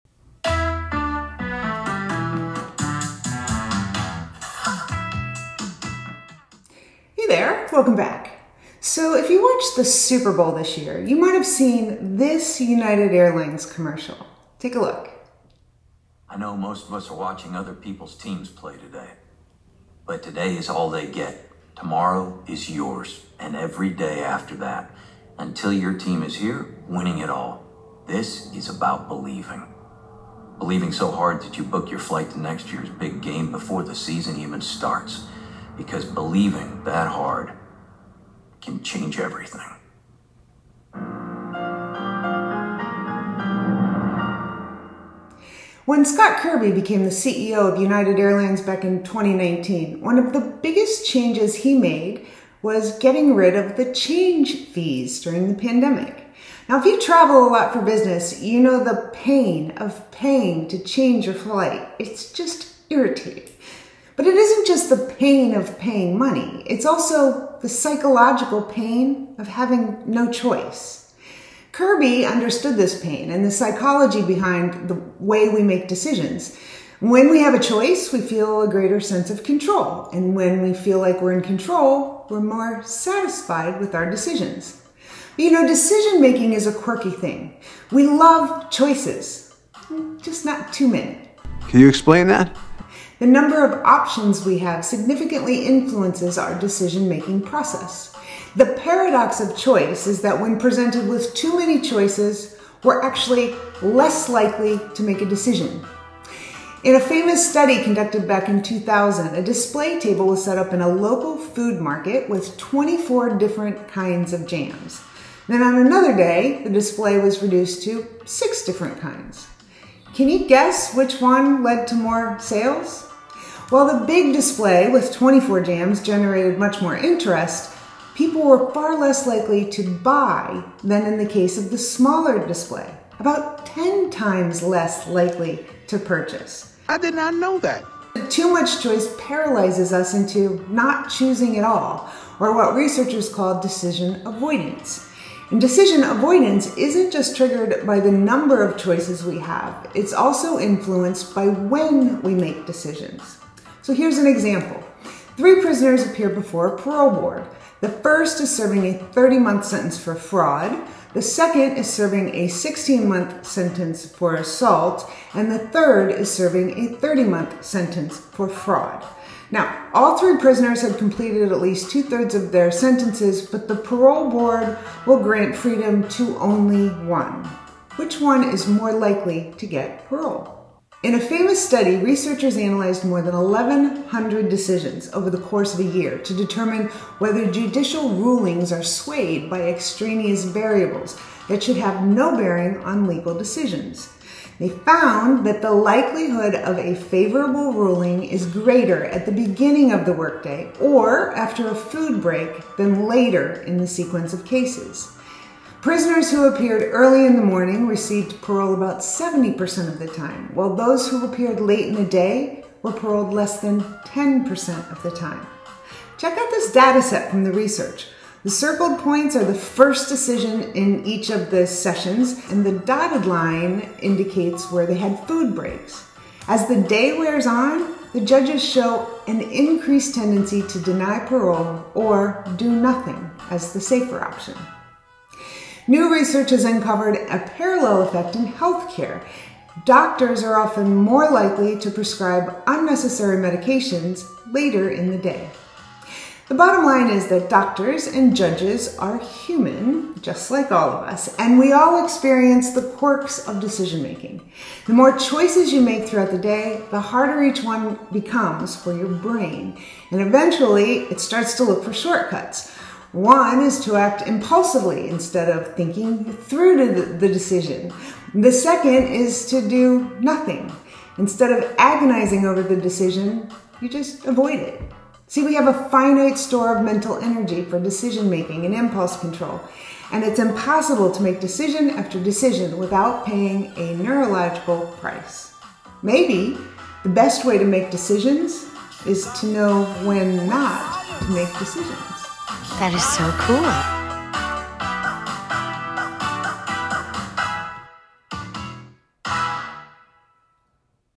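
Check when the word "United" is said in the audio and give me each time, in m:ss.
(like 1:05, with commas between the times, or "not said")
0:12, 0:47.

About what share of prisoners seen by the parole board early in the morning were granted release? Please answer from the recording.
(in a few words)
70%.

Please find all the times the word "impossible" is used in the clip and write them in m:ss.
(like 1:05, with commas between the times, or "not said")
4:40.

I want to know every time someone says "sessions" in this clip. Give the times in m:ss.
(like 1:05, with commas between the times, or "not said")
3:41.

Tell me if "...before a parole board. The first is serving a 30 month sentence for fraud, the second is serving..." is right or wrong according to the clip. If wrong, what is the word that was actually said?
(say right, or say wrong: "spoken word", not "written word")
right.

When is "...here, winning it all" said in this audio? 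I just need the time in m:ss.
0:26.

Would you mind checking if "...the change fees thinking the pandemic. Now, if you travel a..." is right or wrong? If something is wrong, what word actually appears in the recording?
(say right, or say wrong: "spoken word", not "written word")
wrong: "during", not "thinking".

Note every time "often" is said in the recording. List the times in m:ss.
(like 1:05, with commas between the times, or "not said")
4:00.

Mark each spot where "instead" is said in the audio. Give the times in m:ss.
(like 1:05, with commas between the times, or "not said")
4:25, 4:31.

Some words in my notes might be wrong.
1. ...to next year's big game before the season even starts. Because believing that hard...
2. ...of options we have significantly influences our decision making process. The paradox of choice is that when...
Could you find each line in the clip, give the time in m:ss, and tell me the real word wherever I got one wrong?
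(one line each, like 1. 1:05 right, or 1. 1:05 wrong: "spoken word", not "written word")
1. 0:32 right
2. 1:33 right.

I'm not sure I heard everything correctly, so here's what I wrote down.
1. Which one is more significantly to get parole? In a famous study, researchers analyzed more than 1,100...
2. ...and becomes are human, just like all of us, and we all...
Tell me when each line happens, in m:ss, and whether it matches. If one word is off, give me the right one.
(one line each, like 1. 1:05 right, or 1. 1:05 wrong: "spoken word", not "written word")
1. 2:57 wrong: "likely", not "significantly"
2. 4:08 wrong: "judges", not "becomes".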